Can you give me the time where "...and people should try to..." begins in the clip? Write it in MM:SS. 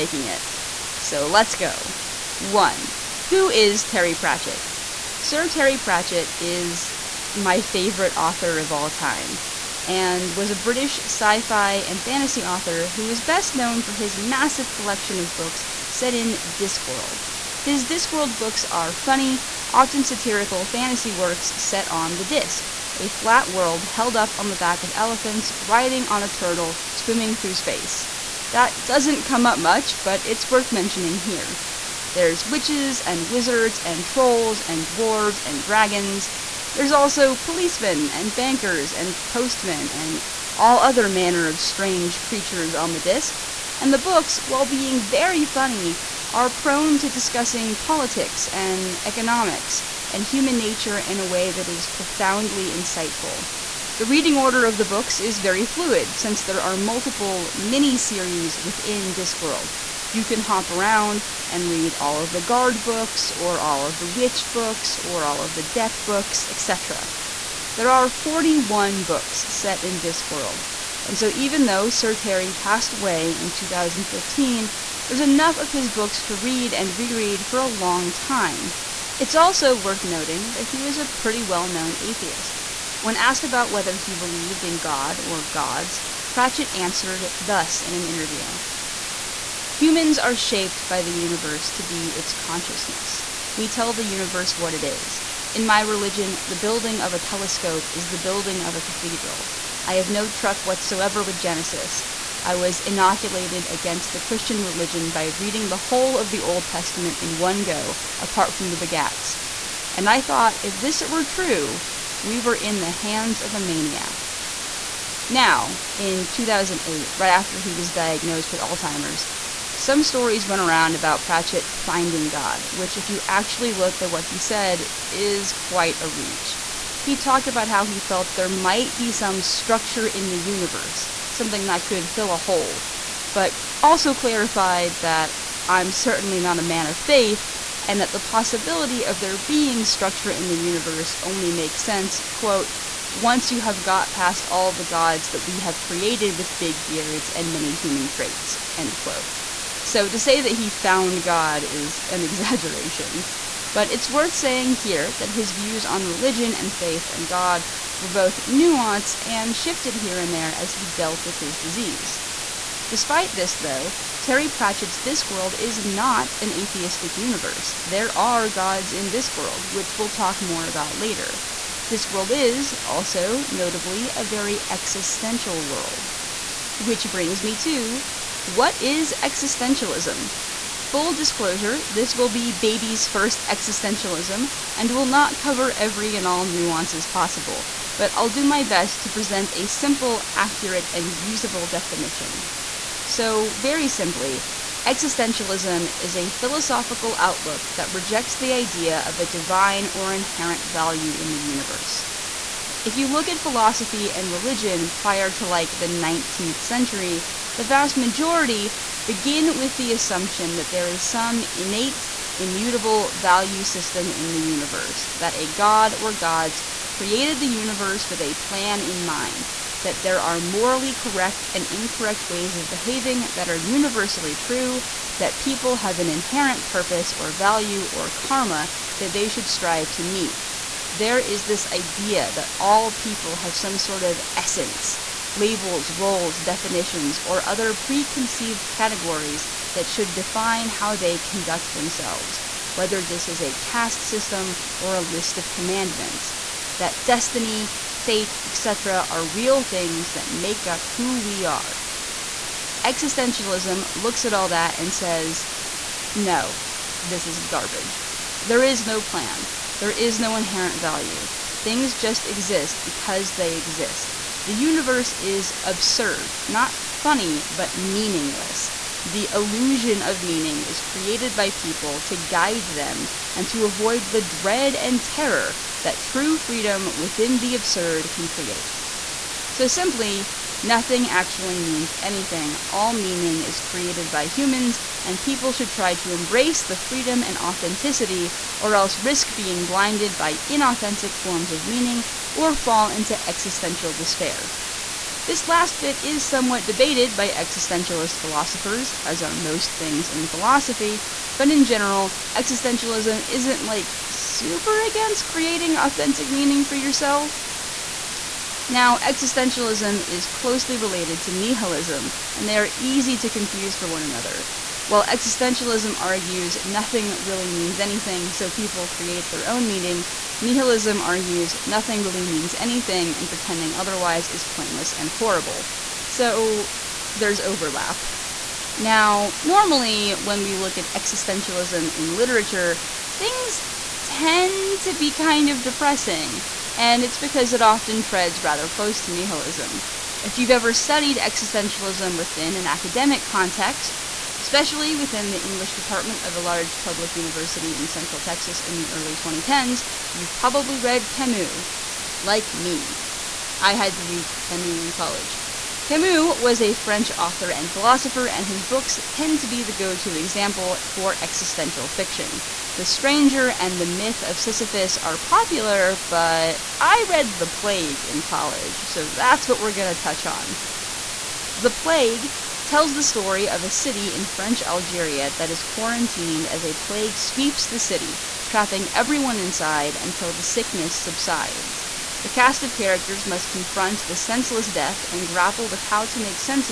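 04:45.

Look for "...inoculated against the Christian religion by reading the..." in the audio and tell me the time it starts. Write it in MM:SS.
01:42.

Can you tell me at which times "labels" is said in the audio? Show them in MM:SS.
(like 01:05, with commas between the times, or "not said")
03:55.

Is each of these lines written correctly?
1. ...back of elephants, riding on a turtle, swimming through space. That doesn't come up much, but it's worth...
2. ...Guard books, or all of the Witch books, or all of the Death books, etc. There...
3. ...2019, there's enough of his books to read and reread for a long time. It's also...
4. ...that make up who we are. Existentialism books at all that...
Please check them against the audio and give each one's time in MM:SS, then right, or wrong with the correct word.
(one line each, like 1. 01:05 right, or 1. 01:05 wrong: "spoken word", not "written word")
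1. 00:24 right
2. 01:02 right
3. 01:13 wrong: "2015", not "2019"
4. 04:10 wrong: "looks", not "books".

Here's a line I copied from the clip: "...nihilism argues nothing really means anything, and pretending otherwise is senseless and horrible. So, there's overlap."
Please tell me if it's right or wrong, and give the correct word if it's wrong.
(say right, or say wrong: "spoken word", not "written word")
wrong: "pointless", not "senseless".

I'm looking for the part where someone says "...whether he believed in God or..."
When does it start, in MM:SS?
01:23.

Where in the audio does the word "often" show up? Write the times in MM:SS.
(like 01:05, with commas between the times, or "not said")
00:19, 05:37.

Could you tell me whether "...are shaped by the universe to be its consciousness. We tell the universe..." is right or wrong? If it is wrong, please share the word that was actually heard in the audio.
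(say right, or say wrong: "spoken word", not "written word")
right.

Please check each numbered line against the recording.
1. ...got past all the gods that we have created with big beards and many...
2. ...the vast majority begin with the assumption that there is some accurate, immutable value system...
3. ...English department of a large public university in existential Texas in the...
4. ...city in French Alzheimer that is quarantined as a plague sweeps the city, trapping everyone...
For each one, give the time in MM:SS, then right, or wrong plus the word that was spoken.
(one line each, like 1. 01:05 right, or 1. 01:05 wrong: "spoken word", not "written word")
1. 02:23 right
2. 03:27 wrong: "innate", not "accurate"
3. 05:45 wrong: "central", not "existential"
4. 06:13 wrong: "Algeria", not "Alzheimer".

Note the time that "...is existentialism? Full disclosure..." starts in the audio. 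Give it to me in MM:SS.
02:58.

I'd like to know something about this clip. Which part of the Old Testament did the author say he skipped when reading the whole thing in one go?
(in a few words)
the begats.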